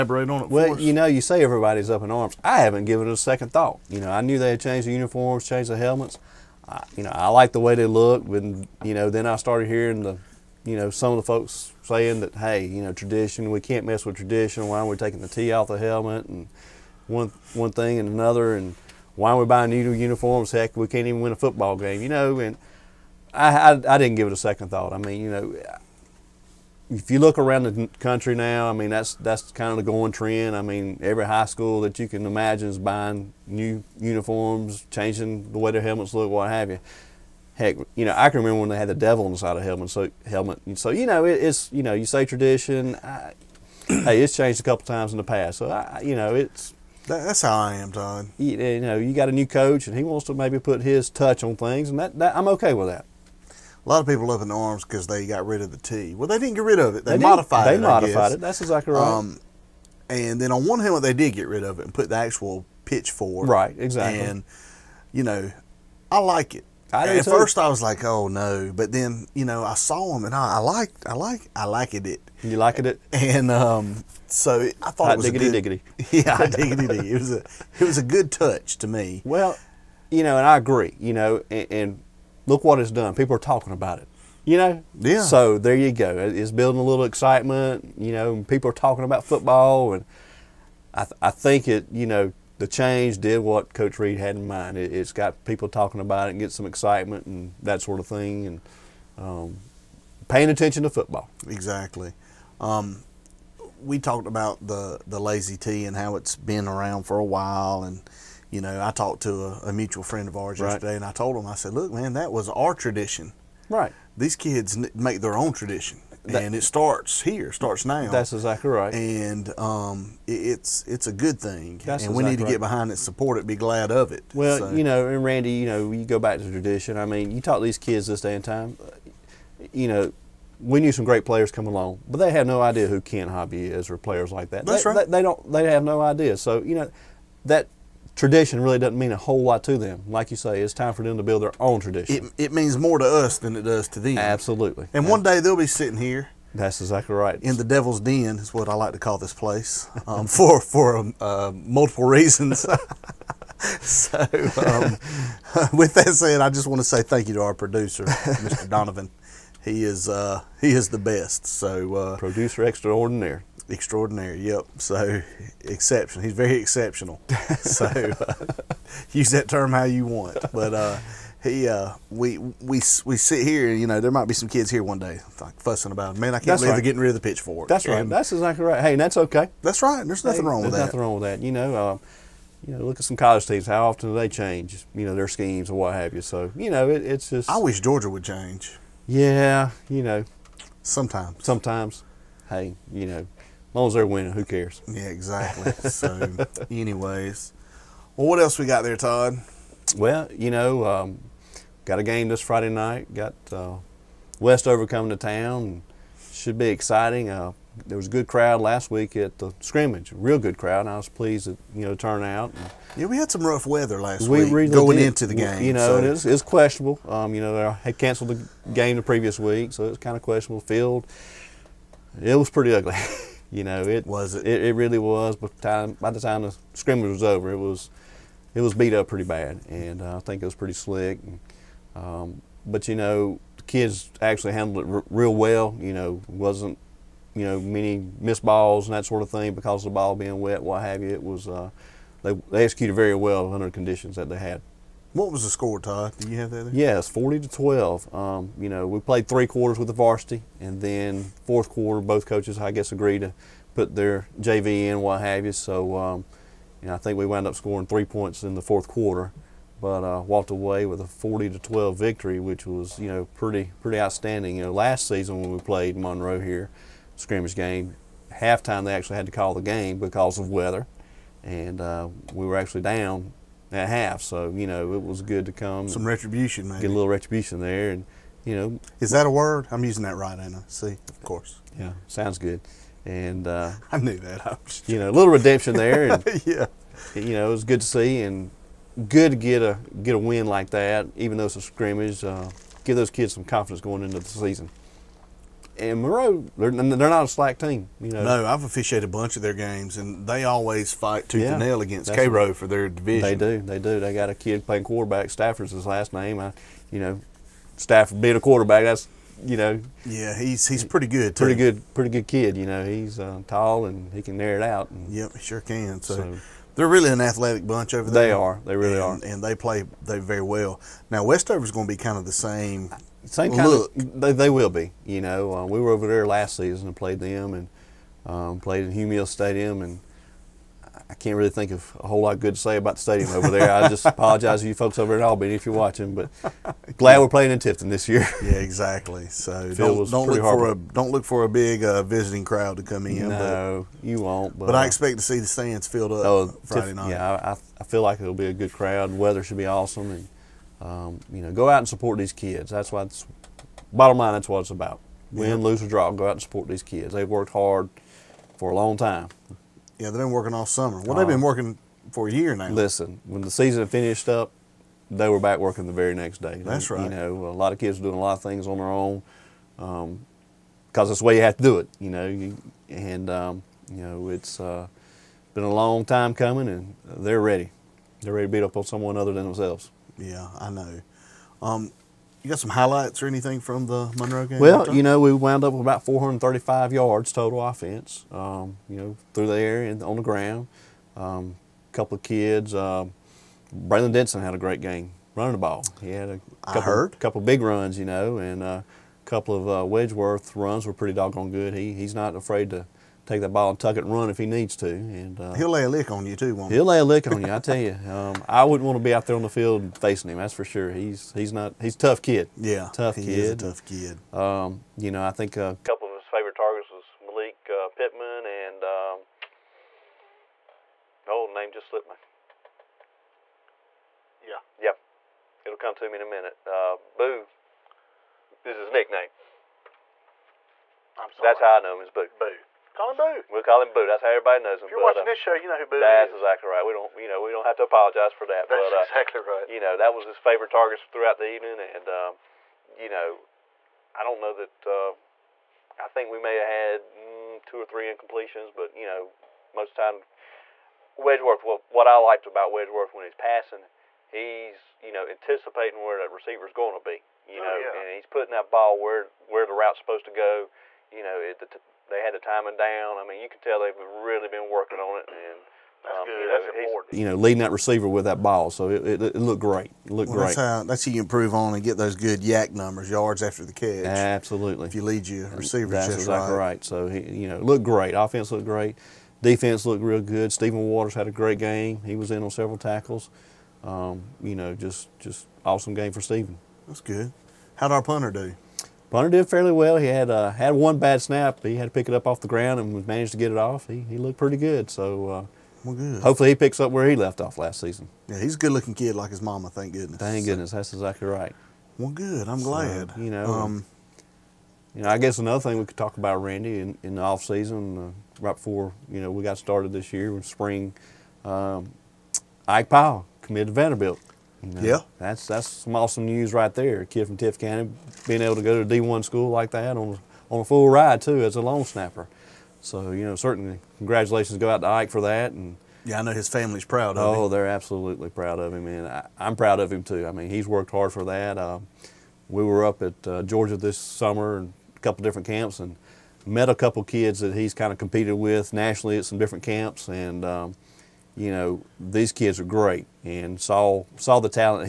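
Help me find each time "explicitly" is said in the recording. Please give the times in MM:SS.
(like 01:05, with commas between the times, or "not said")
not said.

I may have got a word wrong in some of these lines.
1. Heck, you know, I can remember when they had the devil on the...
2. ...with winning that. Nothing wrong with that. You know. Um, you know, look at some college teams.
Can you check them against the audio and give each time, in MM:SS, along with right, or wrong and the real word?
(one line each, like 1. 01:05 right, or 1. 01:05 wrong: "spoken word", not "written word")
1. 00:37 right
2. 03:00 wrong: "nothing", not "winning".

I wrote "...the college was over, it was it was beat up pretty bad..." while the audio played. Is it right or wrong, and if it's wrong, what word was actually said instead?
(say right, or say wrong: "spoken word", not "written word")
wrong: "scrimmage", not "college".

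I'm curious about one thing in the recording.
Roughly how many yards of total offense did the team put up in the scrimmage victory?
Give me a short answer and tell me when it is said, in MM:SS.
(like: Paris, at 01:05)
435, at 06:26.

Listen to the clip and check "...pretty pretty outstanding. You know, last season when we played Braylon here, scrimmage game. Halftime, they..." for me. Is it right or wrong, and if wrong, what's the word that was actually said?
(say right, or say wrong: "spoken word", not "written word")
wrong: "Monroe", not "Braylon".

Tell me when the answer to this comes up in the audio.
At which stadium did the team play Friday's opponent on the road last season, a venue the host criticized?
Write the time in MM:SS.
05:28.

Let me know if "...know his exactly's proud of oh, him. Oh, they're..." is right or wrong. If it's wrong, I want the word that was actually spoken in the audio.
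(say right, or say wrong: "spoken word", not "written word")
wrong: "family", not "exactly".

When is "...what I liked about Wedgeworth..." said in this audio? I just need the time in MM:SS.
07:31.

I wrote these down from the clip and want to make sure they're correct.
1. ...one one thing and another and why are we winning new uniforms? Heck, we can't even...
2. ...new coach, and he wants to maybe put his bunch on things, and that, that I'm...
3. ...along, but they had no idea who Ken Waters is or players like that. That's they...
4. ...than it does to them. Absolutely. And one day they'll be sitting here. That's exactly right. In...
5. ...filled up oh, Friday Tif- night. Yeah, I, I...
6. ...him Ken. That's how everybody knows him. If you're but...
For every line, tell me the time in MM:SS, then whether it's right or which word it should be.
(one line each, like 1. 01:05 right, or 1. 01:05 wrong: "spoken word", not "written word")
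1. 00:17 wrong: "buying", not "winning"
2. 00:49 wrong: "touch", not "bunch"
3. 02:11 wrong: "Hobby", not "Waters"
4. 02:23 right
5. 05:45 right
6. 07:13 wrong: "Boo", not "Ken".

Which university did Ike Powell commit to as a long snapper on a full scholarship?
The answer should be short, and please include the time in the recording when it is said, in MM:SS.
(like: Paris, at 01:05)
Vanderbilt, at 08:33.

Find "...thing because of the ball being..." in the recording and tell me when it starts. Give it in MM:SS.
03:59.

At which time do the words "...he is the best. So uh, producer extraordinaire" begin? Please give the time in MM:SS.
02:40.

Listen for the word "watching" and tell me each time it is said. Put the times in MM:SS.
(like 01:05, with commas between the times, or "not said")
05:35, 07:15.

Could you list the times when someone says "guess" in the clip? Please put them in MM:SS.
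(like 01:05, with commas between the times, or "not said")
04:12, 08:25.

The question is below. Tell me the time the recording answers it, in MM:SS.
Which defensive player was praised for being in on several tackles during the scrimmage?
08:00.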